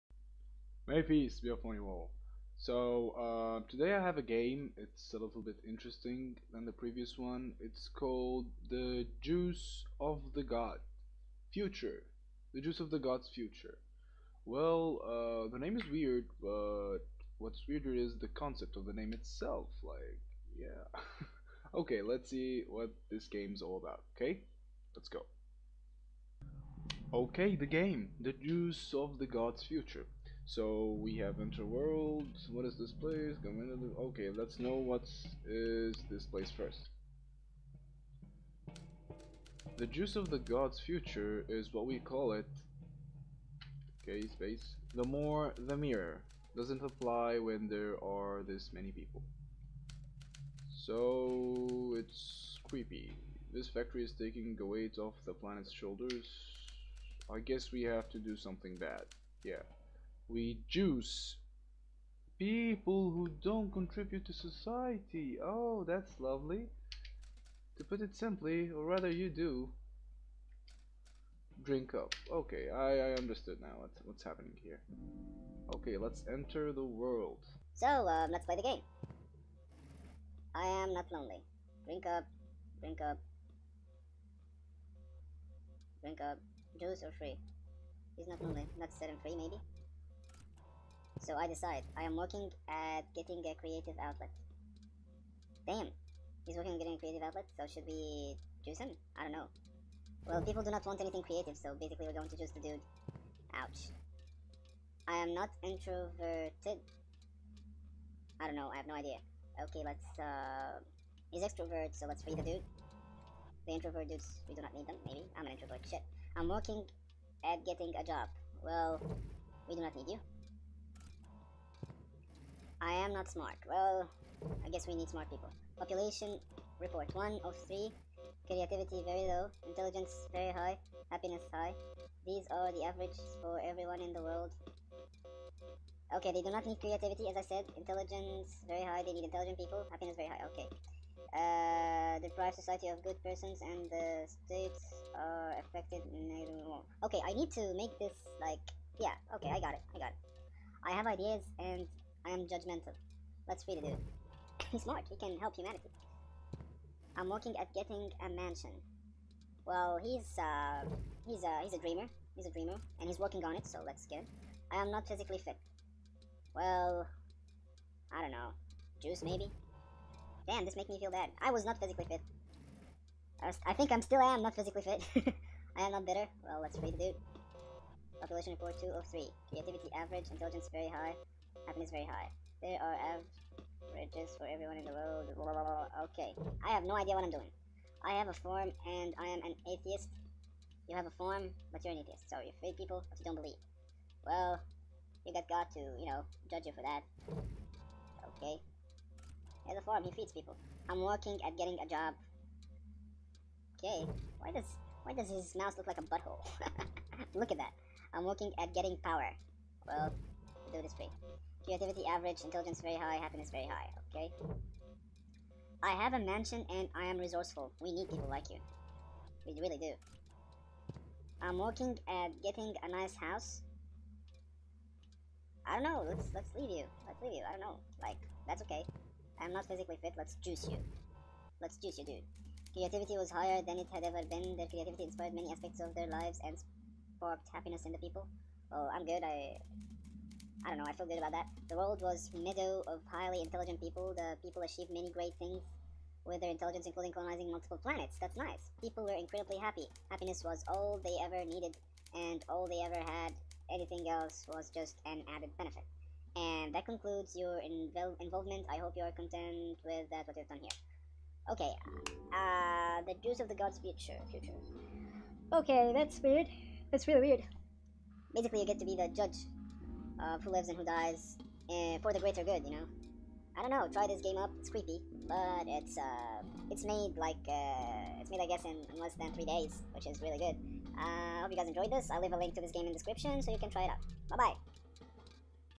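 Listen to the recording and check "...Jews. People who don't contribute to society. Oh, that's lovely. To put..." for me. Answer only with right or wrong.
right.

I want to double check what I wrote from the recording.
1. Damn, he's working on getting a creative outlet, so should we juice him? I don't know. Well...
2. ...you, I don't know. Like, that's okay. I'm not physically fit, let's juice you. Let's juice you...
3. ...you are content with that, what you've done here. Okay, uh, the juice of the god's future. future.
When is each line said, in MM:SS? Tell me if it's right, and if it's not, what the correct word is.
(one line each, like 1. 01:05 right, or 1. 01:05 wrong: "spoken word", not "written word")
1. 01:35 right
2. 03:47 right
3. 04:18 right.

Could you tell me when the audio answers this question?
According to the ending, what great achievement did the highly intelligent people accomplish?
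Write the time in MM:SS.
04:07.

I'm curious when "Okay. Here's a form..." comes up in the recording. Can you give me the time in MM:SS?
03:18.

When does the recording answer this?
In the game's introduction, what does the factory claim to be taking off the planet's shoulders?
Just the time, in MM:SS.
00:54.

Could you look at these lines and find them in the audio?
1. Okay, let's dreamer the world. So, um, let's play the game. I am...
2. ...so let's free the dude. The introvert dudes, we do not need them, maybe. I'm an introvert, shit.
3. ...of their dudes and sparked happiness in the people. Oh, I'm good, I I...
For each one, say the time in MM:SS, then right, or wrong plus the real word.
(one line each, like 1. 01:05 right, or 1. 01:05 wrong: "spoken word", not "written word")
1. 01:15 wrong: "enter", not "dreamer"
2. 01:51 right
3. 03:55 wrong: "lives", not "dudes".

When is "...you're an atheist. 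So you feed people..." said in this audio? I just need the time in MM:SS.
03:11.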